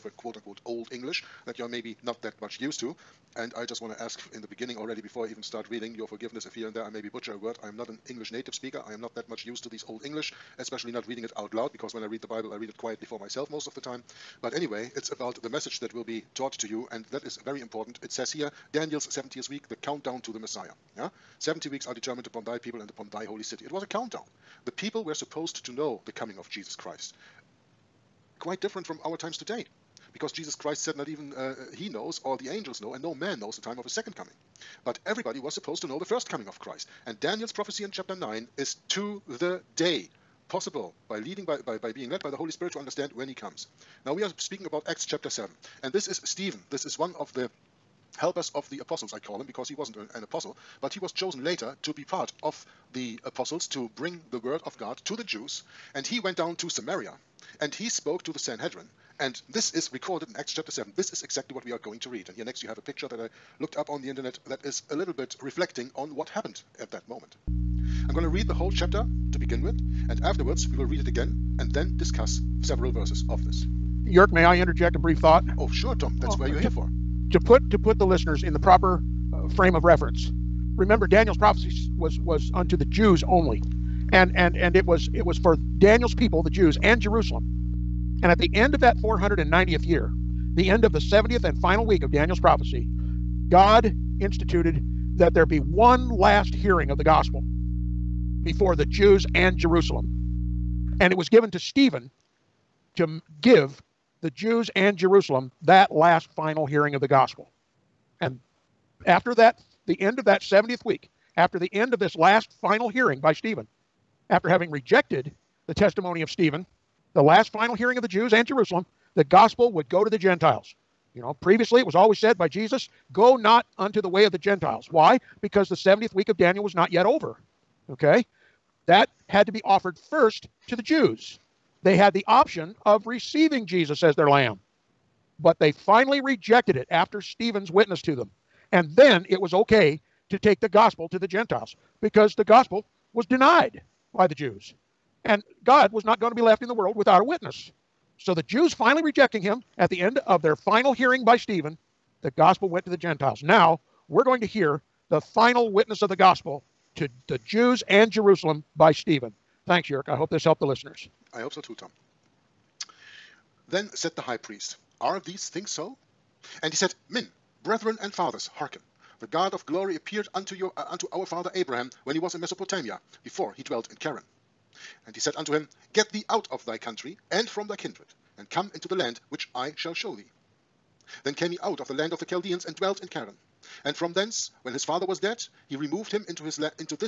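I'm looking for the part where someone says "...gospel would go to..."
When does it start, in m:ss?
1:59.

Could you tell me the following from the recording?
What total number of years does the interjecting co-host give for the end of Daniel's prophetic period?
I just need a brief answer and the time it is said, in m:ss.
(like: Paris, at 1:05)
490, at 1:29.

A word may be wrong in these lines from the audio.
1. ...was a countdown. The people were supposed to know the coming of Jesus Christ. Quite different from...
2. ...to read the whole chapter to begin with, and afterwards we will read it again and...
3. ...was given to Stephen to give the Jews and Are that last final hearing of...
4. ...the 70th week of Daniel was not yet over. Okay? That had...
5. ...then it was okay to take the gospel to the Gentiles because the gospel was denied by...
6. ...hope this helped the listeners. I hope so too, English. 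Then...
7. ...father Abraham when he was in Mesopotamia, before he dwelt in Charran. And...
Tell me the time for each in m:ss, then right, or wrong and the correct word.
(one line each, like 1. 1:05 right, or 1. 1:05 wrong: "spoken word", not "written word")
1. 0:23 right
2. 1:08 right
3. 1:41 wrong: "Jerusalem", not "Are"
4. 2:05 right
5. 2:18 right
6. 2:40 wrong: "Tom", not "English"
7. 2:51 right.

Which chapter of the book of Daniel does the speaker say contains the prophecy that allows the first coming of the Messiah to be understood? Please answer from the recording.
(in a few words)
Chapter 9.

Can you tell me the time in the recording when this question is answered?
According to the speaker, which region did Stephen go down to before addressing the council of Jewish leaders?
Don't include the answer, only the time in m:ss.
0:56.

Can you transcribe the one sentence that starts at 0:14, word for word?
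But anyway, it's about the message that will be taught to you, and that is very important.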